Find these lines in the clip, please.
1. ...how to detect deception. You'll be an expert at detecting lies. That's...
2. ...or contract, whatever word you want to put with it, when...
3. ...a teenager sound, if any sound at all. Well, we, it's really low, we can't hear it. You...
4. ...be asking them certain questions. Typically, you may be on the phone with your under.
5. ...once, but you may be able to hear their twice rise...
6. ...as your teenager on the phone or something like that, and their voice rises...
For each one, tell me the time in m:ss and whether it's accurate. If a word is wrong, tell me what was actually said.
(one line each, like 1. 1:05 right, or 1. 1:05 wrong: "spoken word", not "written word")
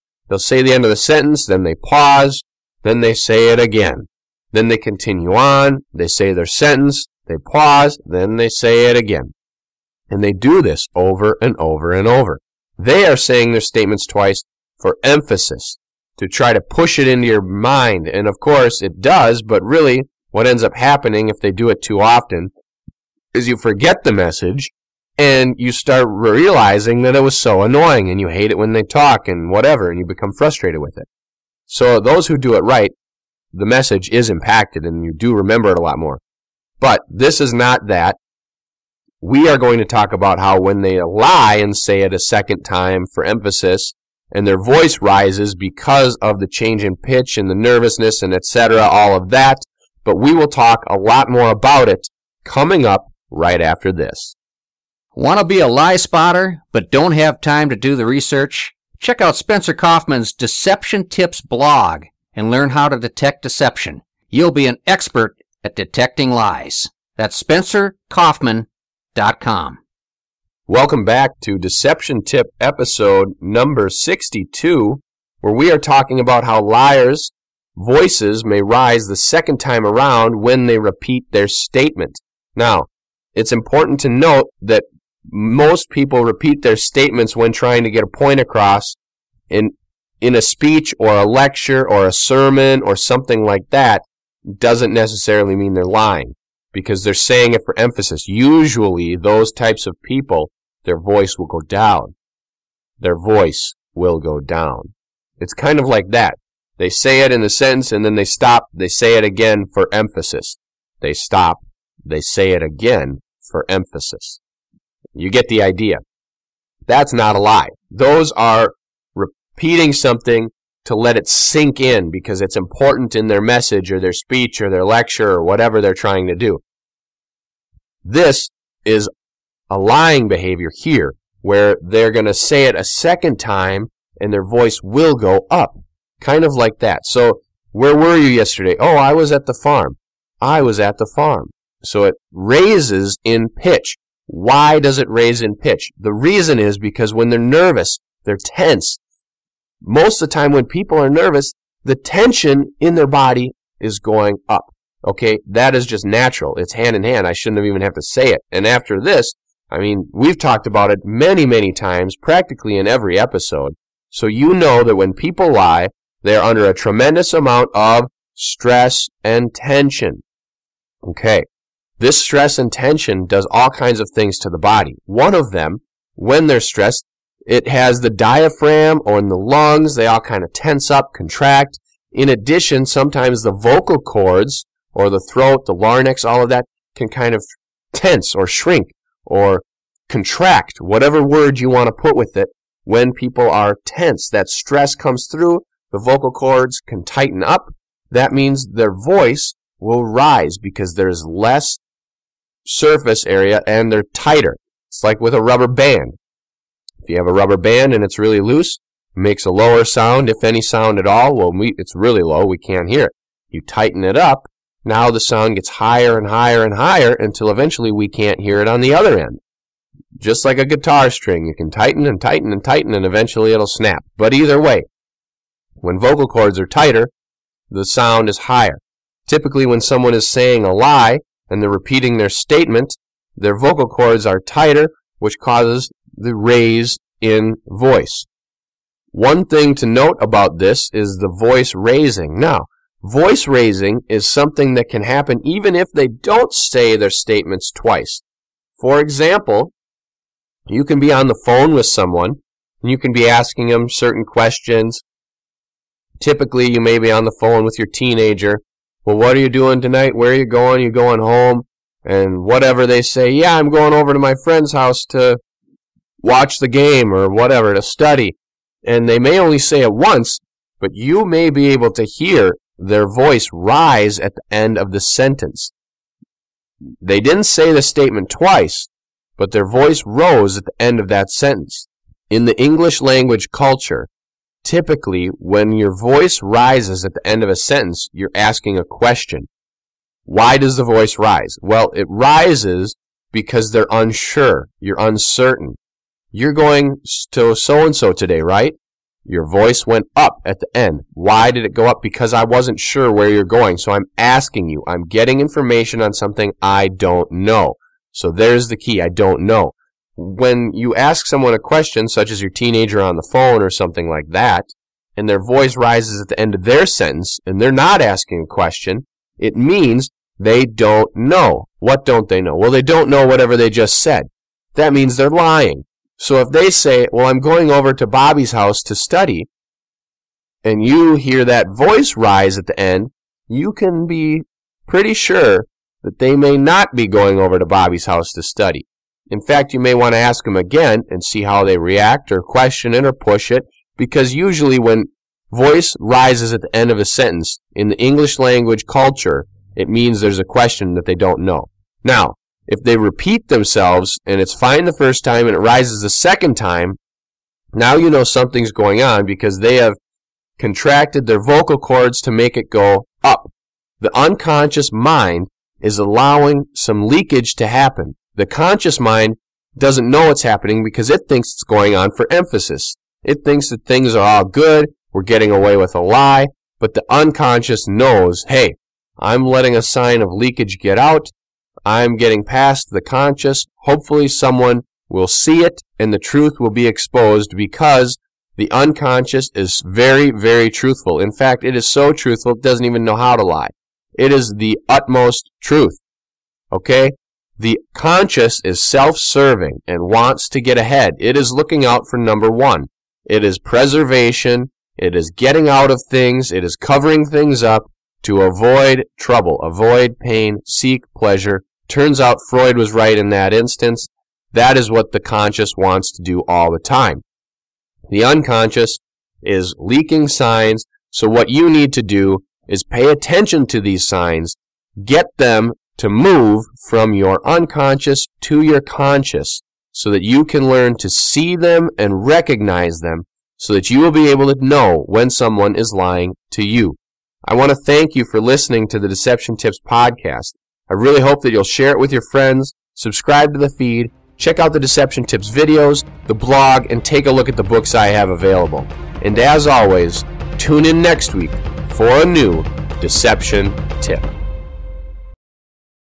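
1. 1:02 right
2. 3:09 right
3. 3:29 wrong: "lower", not "teenager"
4. 4:13 wrong: "teenager", not "under"
5. 4:29 wrong: "voice", not "twice"
6. 5:12 right.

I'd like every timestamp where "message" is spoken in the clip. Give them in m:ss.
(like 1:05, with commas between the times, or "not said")
0:24, 0:33, 2:03.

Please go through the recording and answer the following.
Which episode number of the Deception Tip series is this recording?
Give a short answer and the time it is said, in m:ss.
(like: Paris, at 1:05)
62, at 1:12.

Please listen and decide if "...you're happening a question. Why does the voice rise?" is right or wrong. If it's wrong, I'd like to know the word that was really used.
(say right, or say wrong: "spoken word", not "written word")
wrong: "asking", not "happening".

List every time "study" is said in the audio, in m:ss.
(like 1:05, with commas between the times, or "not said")
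4:27, 5:28, 5:38.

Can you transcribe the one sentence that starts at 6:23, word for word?
Hopefully someone will see it and the truth will be exposed because the unconscious is very, very truthful.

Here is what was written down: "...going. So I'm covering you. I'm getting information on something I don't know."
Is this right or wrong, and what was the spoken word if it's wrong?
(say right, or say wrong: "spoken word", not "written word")
wrong: "asking", not "covering".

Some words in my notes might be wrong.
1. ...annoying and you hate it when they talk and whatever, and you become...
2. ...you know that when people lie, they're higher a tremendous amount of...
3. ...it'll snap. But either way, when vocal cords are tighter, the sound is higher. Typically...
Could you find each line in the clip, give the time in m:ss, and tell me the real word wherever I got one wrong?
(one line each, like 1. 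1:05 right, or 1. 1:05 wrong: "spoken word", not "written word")
1. 0:27 right
2. 2:44 wrong: "under", not "higher"
3. 3:43 right.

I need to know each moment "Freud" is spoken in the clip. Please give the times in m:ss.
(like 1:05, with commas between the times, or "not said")
6:52.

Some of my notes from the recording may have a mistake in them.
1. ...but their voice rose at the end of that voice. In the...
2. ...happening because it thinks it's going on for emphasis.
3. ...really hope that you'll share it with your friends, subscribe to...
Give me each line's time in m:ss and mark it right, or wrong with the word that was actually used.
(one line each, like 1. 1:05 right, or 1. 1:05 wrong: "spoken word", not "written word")
1. 4:39 wrong: "sentence", not "voice"
2. 6:10 right
3. 7:20 right.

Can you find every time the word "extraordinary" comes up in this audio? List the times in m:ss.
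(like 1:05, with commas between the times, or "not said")
not said.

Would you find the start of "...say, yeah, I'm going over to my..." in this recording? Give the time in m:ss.
4:23.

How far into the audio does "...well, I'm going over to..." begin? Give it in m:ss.
5:27.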